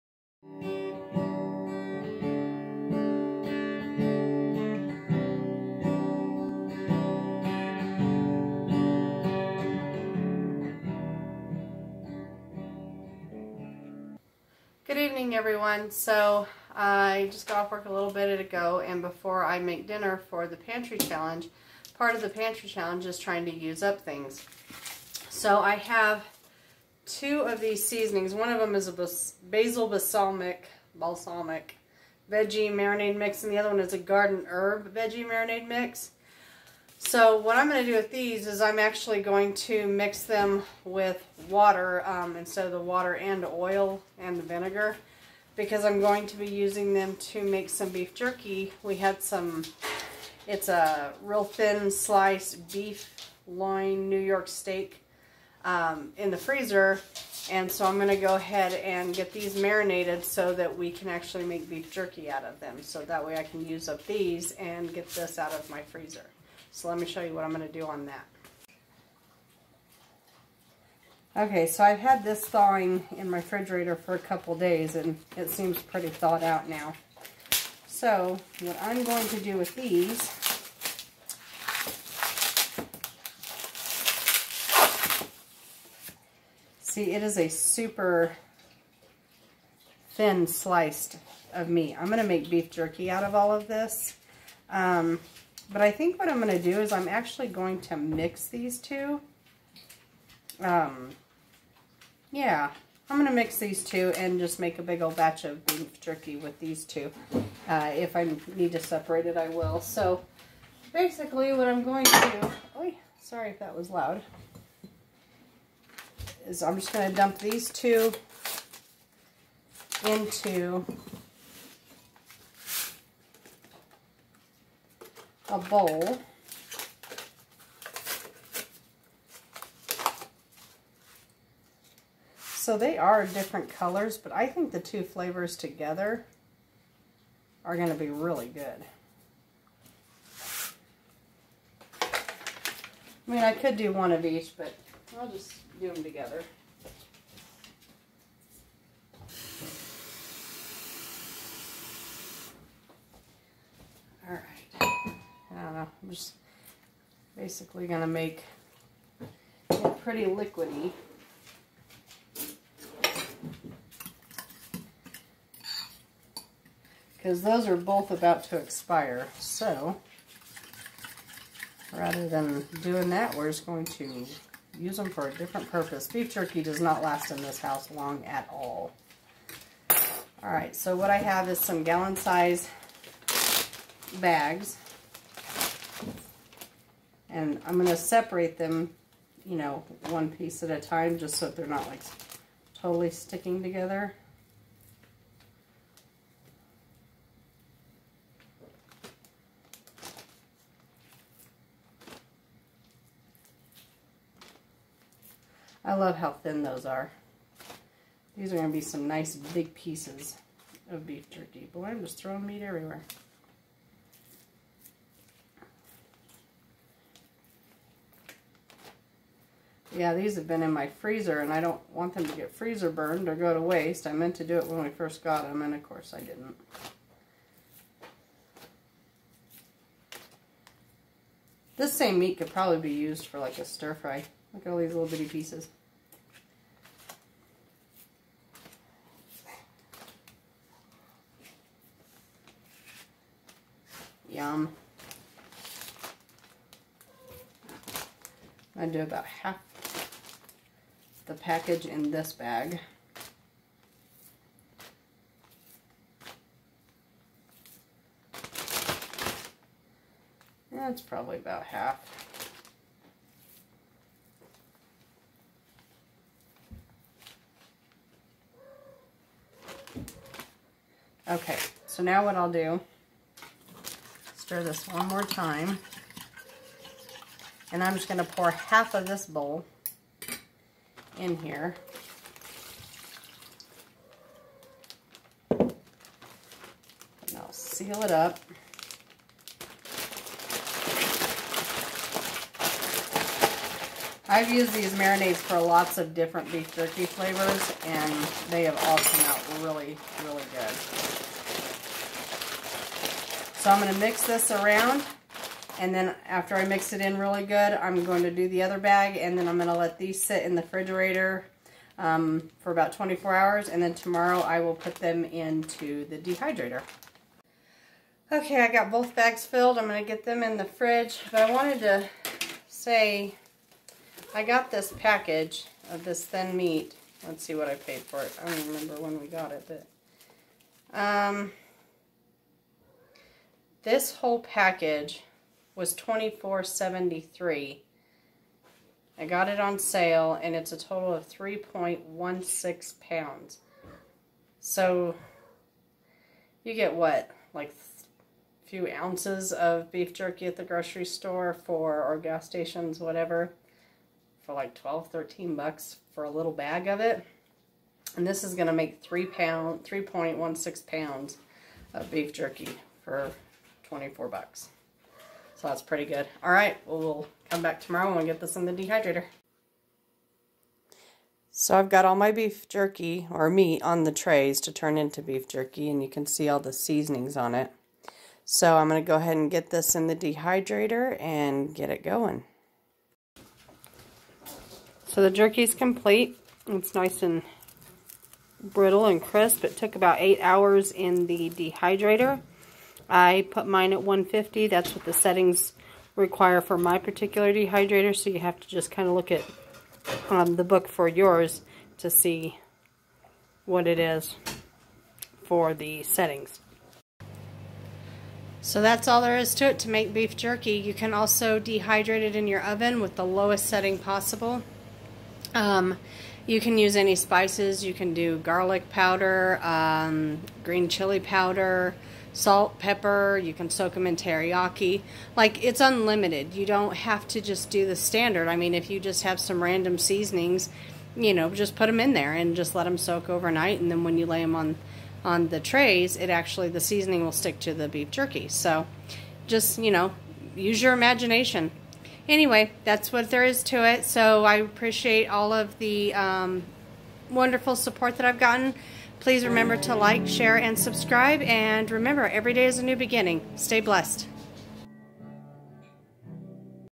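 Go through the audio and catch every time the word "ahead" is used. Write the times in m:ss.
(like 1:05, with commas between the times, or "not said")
0:58, 6:19.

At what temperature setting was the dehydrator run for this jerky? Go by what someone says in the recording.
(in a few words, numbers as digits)
150.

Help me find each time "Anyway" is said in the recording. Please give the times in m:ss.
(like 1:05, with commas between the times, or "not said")
7:22.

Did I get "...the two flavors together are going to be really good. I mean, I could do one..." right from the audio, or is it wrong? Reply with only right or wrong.
right.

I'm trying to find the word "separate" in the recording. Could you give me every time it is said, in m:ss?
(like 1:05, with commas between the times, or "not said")
1:48, 3:07.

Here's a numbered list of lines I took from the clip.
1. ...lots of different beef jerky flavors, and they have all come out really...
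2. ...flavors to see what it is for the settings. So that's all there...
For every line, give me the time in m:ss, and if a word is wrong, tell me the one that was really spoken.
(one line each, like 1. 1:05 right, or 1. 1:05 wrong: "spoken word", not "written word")
1. 4:55 right
2. 6:41 wrong: "yours", not "flavors".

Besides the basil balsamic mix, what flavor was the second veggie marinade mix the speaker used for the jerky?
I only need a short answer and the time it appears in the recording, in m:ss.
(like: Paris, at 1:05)
Garden herb, at 0:33.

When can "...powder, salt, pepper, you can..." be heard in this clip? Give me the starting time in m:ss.
7:01.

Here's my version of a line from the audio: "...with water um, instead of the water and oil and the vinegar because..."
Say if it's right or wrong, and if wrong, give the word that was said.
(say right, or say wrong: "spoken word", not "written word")
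right.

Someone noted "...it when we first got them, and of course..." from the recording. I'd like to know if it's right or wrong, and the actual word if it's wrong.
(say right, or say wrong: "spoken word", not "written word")
right.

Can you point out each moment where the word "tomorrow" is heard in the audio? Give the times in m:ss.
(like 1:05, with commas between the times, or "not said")
5:13, 6:07.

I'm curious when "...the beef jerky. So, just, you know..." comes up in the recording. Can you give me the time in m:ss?
7:17.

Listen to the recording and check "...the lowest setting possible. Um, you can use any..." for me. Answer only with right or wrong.
right.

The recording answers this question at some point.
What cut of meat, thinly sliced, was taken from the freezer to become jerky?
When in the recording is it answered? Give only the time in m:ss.
0:52.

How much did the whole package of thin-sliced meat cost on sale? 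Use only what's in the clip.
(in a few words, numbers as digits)
$24.73.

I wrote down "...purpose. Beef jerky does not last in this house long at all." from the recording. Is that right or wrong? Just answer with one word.
right.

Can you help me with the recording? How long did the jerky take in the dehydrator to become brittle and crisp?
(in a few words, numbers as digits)
8 hours.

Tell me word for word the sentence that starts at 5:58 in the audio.
And this is going to make 3 pound, 3.16 pounds of beef jerky for 24 bucks.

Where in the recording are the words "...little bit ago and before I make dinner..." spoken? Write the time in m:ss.
0:17.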